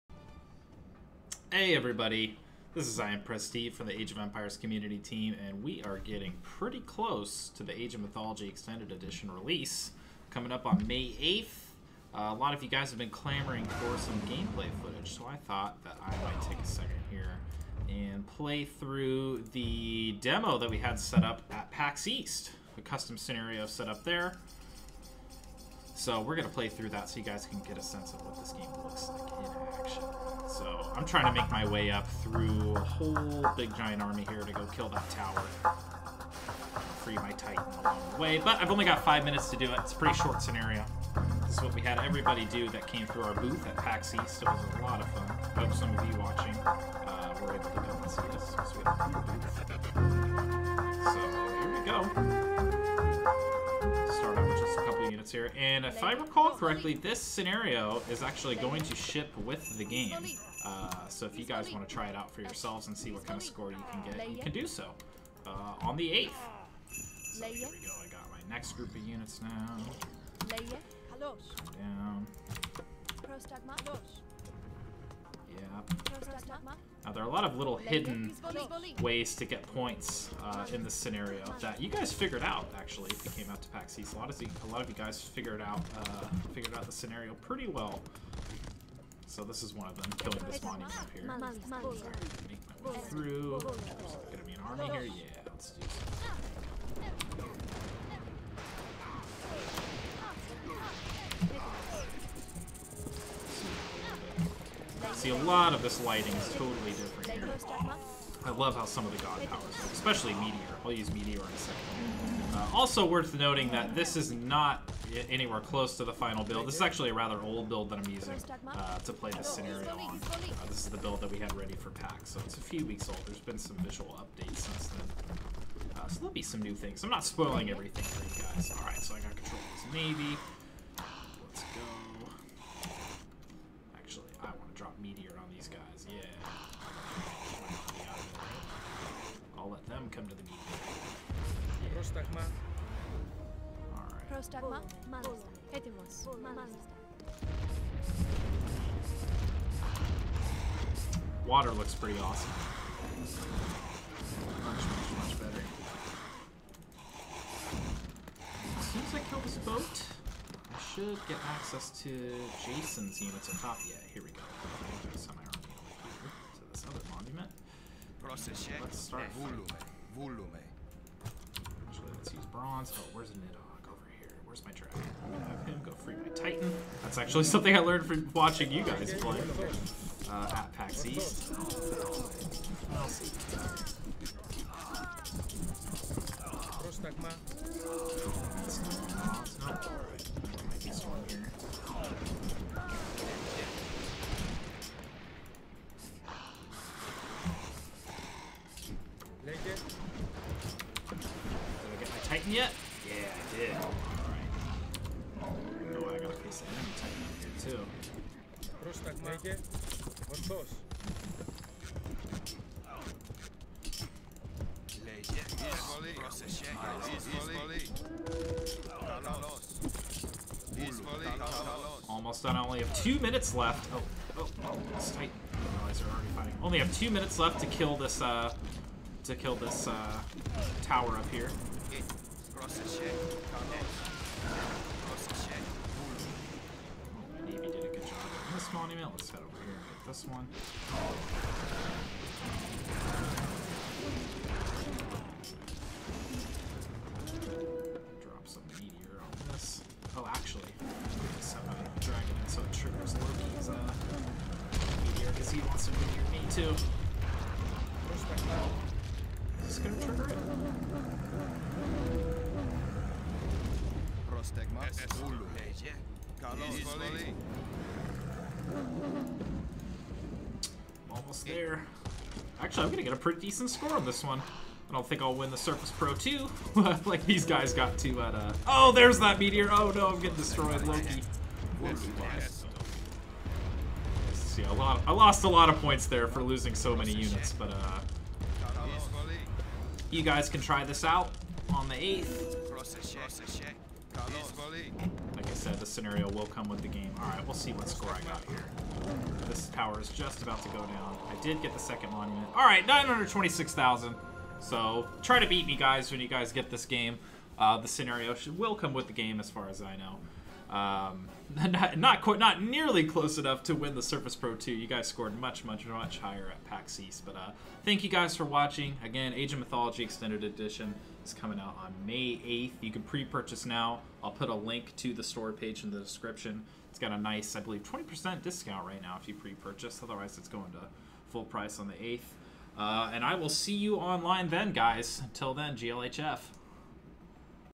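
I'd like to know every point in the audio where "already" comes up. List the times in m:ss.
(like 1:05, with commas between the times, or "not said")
3:46.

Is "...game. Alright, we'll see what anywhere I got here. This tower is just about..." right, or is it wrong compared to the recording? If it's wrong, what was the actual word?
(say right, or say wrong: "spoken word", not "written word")
wrong: "score", not "anywhere".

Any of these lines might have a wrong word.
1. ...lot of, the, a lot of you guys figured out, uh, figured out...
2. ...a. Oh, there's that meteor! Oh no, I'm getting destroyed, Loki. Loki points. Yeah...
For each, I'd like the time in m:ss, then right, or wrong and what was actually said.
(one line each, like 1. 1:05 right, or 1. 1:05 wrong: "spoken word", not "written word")
1. 1:24 right
2. 4:38 right.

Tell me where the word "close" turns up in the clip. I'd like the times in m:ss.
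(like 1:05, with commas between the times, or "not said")
0:06, 1:55, 5:13.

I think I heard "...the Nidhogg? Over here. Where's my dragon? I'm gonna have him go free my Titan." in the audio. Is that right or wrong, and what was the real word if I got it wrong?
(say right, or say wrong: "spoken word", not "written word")
right.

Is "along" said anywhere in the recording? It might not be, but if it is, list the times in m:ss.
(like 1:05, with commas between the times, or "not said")
0:37.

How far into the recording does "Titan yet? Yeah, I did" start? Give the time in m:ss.
3:22.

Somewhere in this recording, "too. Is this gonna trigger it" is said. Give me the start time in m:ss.
4:16.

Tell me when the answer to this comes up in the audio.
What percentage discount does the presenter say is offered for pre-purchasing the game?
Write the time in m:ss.
5:27.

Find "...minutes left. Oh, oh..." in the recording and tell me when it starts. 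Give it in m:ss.
3:43.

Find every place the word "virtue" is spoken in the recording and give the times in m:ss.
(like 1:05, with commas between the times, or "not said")
not said.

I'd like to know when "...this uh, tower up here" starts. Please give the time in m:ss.
3:49.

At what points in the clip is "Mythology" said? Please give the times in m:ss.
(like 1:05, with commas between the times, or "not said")
0:07, 5:19.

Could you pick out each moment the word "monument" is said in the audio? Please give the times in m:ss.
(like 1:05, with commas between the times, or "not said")
1:30, 2:47, 5:02.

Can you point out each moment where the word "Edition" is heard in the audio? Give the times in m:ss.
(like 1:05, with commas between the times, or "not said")
0:08, 5:20.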